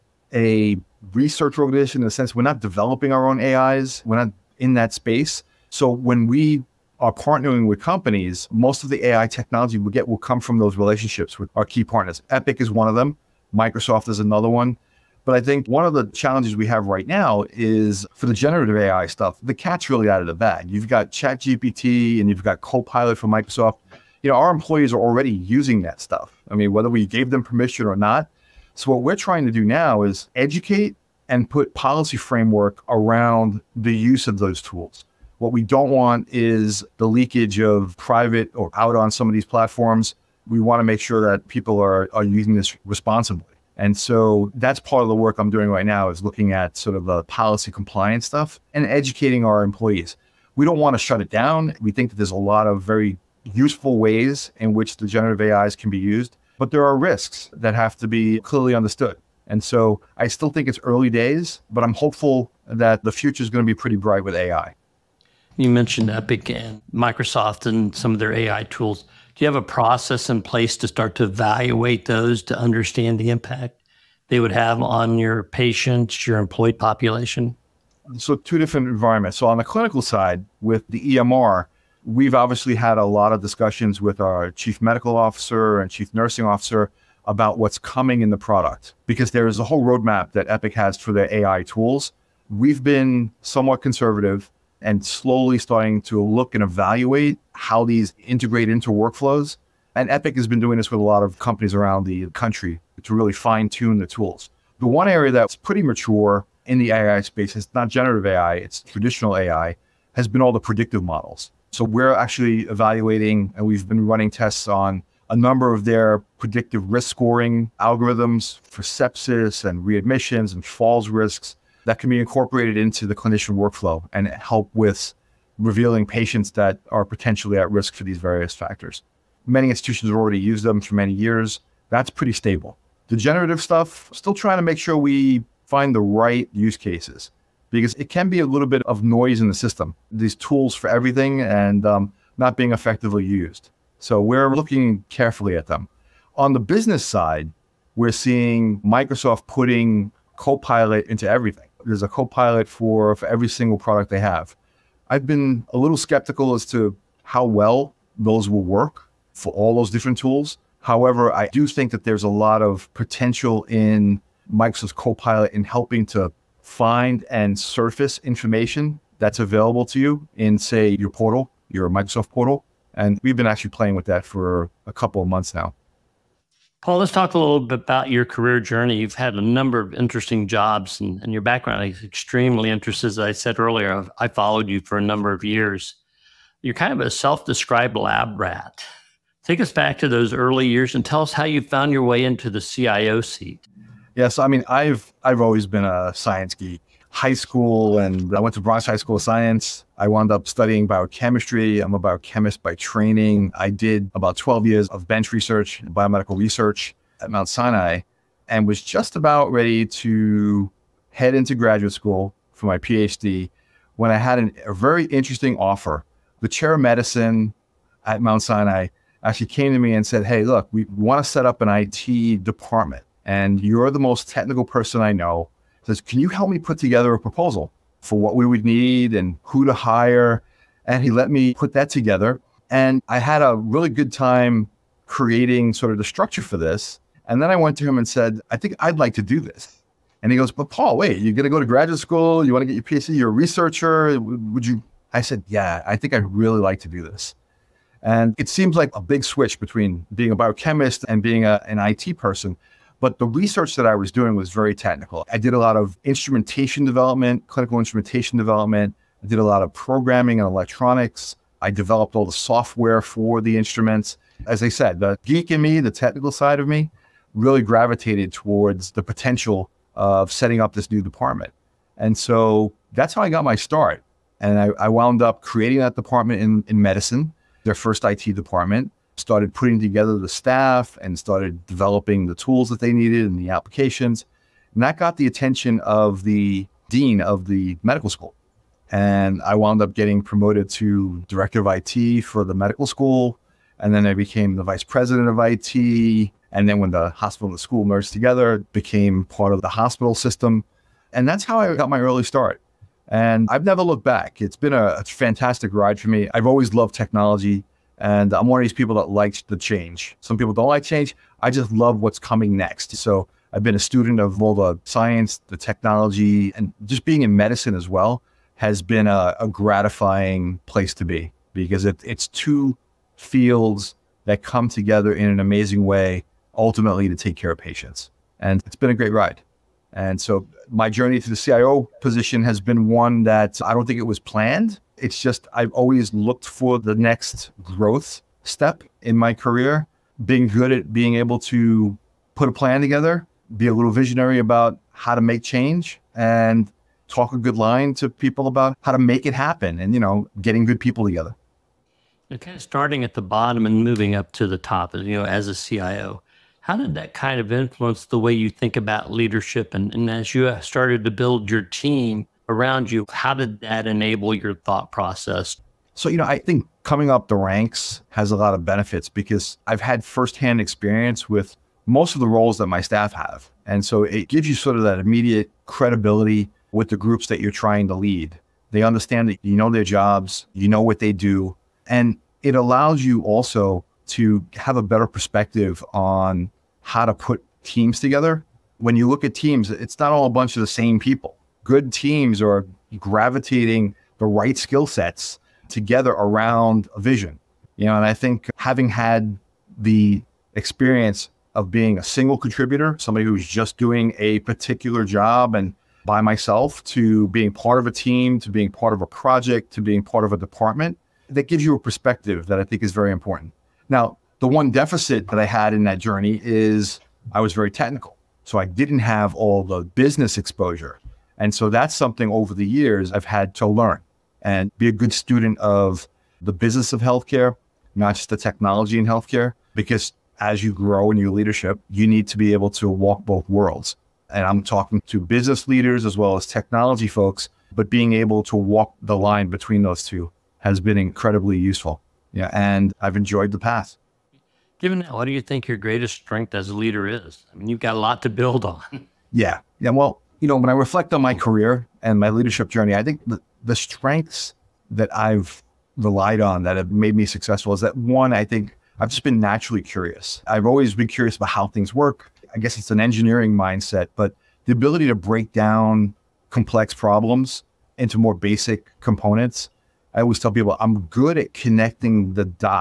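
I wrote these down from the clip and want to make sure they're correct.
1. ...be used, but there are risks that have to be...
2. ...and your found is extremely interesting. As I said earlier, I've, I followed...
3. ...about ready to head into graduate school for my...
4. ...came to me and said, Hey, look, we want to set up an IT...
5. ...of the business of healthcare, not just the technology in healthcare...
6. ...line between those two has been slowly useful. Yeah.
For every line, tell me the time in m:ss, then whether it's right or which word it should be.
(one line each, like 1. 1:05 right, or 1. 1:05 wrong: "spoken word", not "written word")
1. 0:55 right
2. 3:01 wrong: "background", not "found"
3. 3:29 right
4. 3:39 right
5. 7:05 right
6. 7:19 wrong: "incredibly", not "slowly".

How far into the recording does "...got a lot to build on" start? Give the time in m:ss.
7:27.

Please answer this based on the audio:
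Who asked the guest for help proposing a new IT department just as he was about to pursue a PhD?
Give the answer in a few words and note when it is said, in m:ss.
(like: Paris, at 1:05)
The chair of medicine, at 3:36.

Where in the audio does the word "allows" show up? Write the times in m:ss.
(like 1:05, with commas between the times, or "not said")
6:22.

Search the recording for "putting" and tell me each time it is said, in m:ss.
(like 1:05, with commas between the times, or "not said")
2:29, 4:39.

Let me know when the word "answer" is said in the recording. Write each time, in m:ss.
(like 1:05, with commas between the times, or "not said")
not said.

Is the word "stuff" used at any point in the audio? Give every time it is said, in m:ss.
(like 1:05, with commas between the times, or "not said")
0:19, 0:25, 0:48, 2:13.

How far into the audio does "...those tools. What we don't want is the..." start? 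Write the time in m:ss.
0:34.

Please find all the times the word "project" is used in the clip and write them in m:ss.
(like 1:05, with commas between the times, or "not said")
6:49.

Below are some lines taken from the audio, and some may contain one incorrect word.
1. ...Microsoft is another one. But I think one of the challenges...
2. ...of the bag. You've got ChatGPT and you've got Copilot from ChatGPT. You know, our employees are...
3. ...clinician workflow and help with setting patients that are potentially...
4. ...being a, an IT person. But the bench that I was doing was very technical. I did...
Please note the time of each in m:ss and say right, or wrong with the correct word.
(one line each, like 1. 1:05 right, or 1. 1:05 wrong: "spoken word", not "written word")
1. 0:13 right
2. 0:20 wrong: "Microsoft", not "ChatGPT"
3. 2:03 wrong: "revealing", not "setting"
4. 4:11 wrong: "research", not "bench".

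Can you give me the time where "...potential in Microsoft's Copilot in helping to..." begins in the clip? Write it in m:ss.
2:42.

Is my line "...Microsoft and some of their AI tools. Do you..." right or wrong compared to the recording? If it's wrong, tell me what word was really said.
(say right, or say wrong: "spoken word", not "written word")
right.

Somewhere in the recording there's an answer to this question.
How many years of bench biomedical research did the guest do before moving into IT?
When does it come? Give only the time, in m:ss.
3:24.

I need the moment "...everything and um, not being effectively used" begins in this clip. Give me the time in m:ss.
2:20.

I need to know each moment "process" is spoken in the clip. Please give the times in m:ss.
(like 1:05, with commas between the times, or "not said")
1:09, 6:04.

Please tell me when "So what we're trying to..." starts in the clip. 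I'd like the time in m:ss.
0:28.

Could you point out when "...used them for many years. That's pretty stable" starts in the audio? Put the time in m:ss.
2:10.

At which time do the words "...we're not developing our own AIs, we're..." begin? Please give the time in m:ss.
0:02.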